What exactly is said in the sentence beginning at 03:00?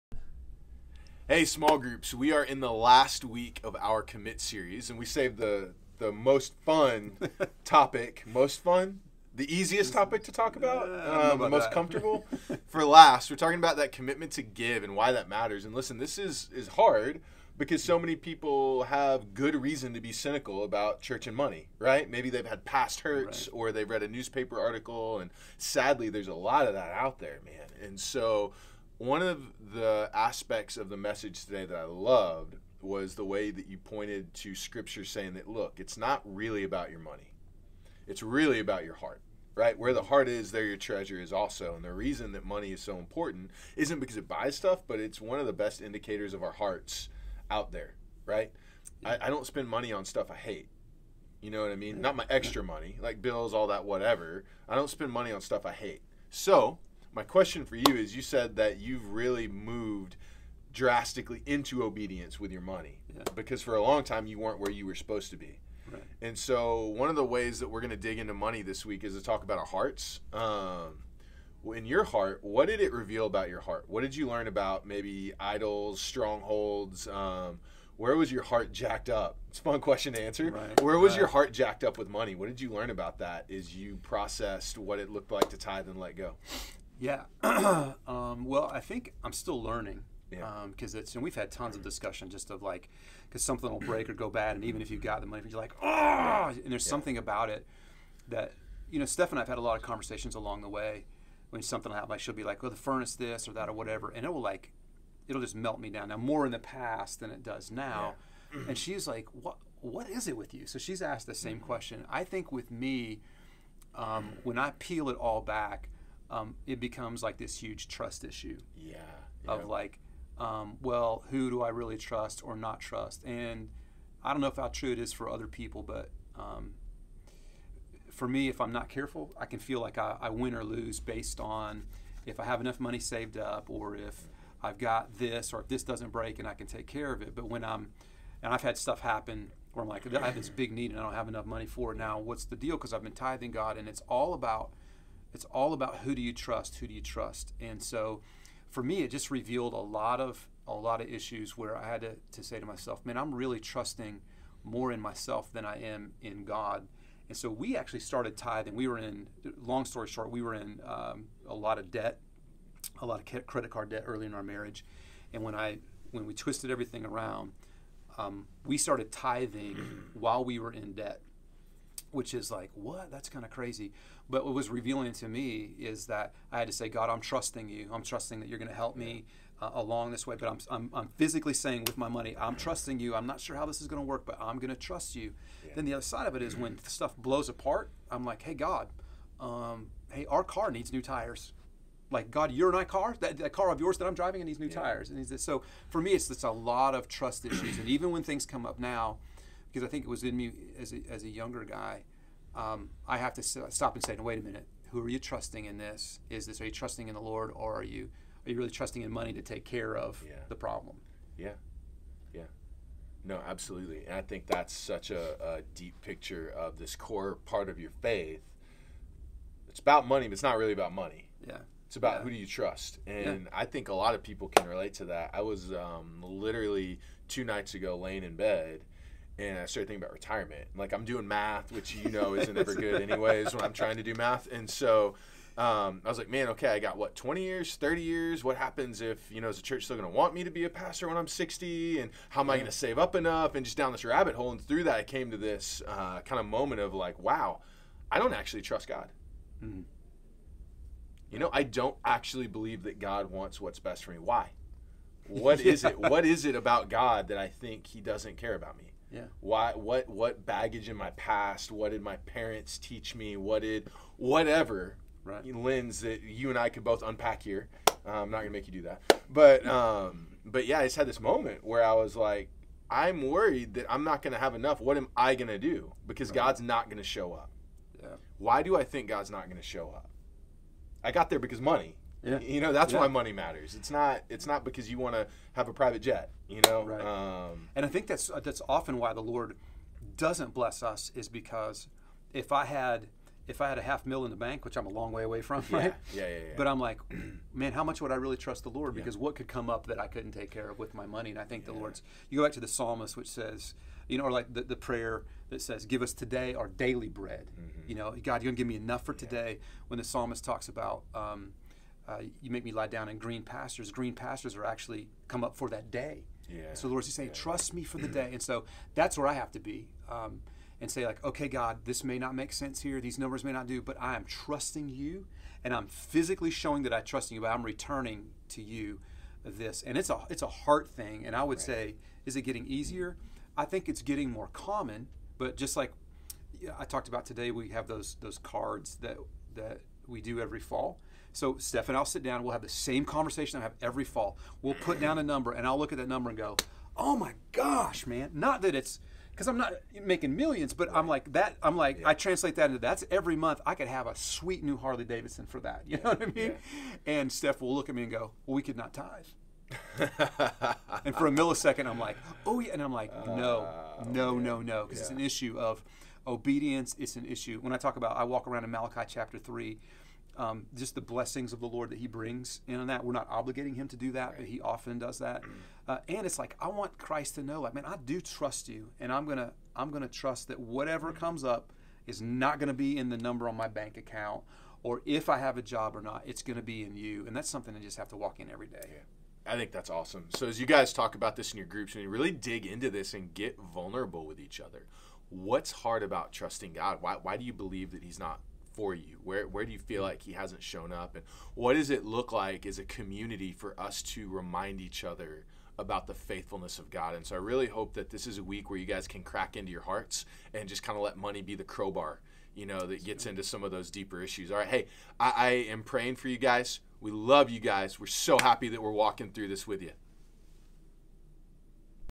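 But I'm, I'm, I'm, physically saying with my money, I'm trusting you.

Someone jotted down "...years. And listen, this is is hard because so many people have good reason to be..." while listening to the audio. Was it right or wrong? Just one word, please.
wrong.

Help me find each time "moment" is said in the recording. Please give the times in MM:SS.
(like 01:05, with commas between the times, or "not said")
04:06, 04:31.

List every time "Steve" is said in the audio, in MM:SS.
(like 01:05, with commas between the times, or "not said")
not said.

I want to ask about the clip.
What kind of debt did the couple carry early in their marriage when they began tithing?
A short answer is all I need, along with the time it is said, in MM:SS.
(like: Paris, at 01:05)
credit card debt, at 02:43.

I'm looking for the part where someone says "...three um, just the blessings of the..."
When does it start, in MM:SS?
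06:09.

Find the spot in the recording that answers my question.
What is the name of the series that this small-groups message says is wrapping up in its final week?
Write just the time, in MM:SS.
00:04.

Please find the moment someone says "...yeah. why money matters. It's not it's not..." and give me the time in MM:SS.
04:42.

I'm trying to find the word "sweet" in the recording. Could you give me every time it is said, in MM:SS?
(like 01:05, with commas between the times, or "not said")
05:54.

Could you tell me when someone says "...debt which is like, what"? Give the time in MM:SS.
02:50.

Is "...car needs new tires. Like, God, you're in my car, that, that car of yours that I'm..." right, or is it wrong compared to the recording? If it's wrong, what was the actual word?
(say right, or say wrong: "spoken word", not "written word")
right.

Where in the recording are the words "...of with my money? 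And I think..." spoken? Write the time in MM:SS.
05:00.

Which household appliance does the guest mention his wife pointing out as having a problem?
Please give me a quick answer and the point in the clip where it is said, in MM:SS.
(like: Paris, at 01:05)
furnace, at 01:42.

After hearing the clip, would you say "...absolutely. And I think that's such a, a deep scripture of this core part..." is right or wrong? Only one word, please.
wrong.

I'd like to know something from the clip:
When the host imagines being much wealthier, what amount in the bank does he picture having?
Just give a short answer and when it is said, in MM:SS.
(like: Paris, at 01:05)
half mil, at 04:53.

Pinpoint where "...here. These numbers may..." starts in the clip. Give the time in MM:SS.
05:22.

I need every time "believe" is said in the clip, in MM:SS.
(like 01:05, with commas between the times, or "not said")
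04:12, 06:37.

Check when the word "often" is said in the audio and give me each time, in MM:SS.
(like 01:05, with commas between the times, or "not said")
04:48, 06:14.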